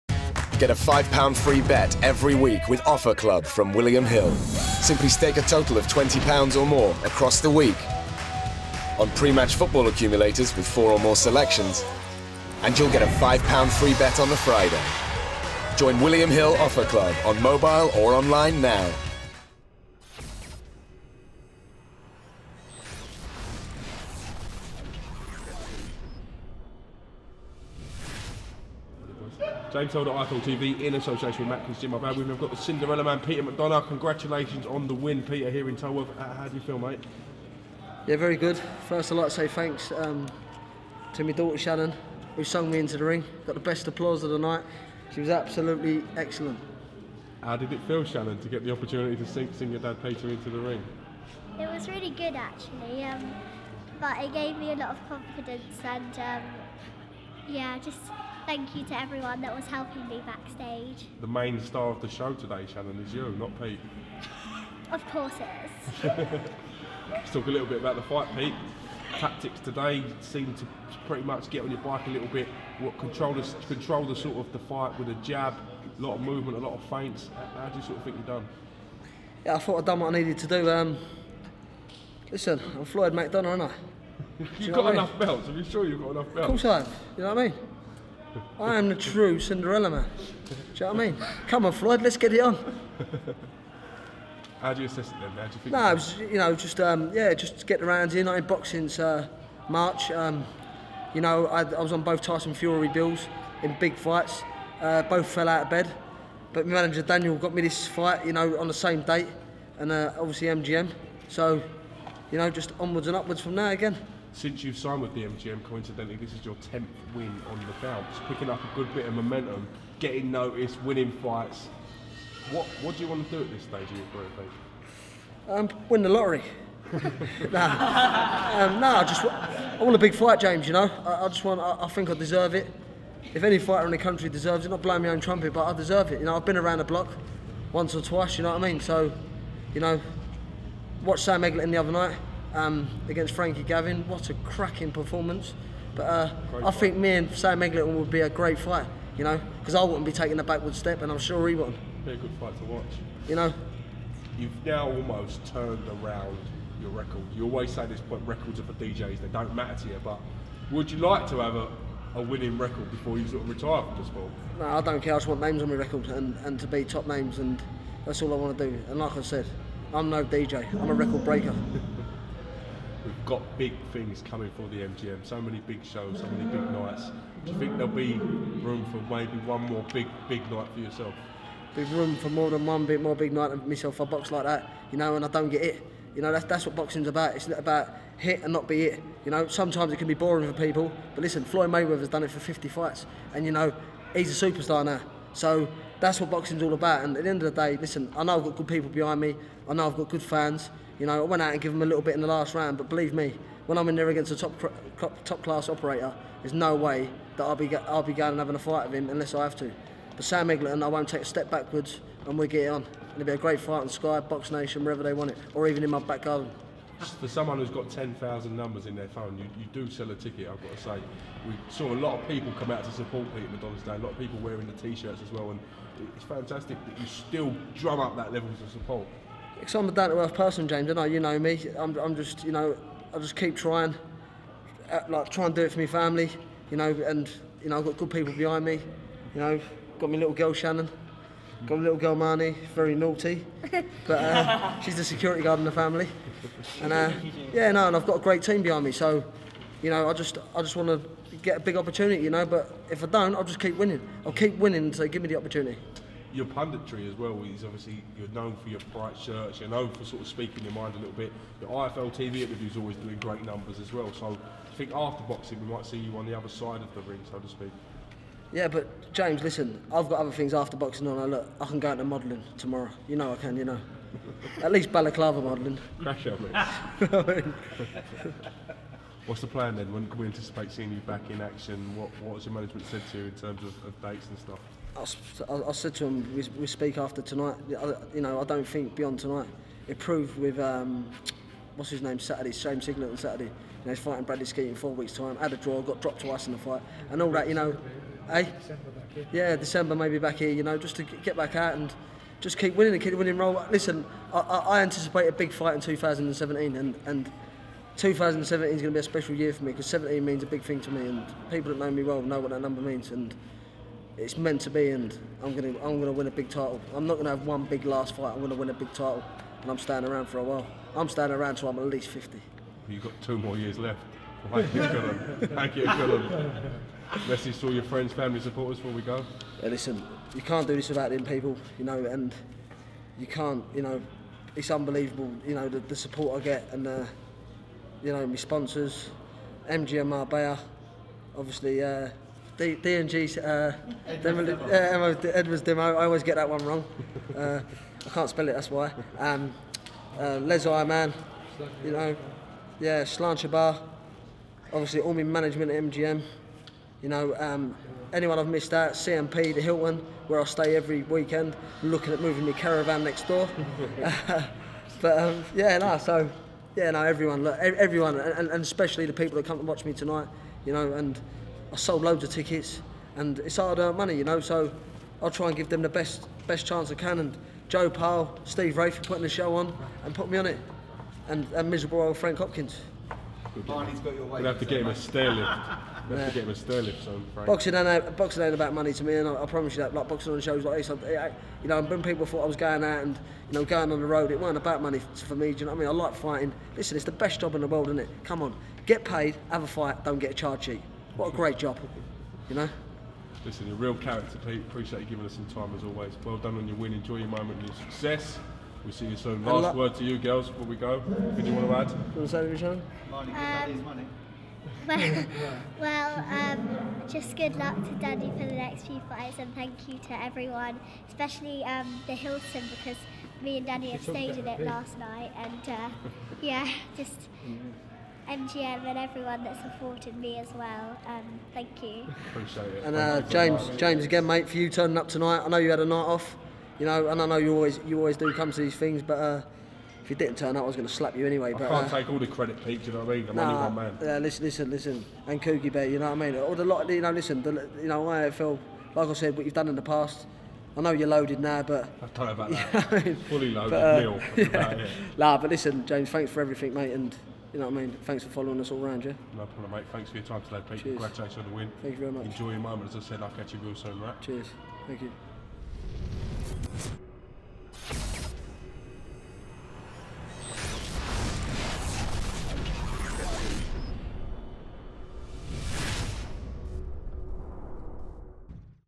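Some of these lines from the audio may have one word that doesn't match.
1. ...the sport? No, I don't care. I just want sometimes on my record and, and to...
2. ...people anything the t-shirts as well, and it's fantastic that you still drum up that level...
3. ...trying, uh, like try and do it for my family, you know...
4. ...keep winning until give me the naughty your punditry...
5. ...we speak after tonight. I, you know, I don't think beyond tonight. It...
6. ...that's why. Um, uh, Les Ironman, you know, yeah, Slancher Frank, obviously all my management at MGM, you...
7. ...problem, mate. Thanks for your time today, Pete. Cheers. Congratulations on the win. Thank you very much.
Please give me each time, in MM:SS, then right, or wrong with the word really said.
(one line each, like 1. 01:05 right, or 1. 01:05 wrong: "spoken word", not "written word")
1. 02:43 wrong: "names", not "sometimes"
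2. 03:44 wrong: "wearing", not "anything"
3. 03:53 right
4. 04:14 wrong: "opportunity", not "naughty"
5. 04:46 right
6. 05:48 wrong: "Bar", not "Frank"
7. 07:39 right.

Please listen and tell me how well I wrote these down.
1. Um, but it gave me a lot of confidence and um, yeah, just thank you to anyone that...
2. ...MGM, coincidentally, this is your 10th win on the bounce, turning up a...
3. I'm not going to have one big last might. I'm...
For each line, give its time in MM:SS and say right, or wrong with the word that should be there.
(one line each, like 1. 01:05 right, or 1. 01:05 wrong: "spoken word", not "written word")
1. 00:53 wrong: "everyone", not "anyone"
2. 01:55 wrong: "picking", not "turning"
3. 05:16 wrong: "fight", not "might".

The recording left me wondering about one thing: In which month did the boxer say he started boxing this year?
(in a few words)
March.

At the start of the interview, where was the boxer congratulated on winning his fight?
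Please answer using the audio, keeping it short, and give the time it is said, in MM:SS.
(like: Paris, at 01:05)
Tolworth, at 00:35.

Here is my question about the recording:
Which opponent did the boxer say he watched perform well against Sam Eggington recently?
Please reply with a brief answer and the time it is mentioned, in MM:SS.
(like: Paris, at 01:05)
Frankie Gavin, at 02:23.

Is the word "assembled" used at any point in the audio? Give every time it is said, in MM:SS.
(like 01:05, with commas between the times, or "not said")
not said.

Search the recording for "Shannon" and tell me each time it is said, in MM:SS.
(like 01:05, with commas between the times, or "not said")
00:41, 00:48, 01:02, 04:00.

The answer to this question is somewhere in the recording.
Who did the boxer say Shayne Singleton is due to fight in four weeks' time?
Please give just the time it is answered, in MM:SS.
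04:54.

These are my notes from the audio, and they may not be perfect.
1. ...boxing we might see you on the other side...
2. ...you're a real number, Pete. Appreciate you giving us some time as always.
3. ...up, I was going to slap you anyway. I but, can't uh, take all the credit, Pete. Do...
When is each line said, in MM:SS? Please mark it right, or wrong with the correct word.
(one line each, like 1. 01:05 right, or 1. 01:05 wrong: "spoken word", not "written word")
1. 04:25 right
2. 06:43 wrong: "character", not "number"
3. 07:20 right.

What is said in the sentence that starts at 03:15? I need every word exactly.
So that's what boxing's all about.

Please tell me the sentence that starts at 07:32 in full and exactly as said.
I mean, Fully loaded but, uh, meal.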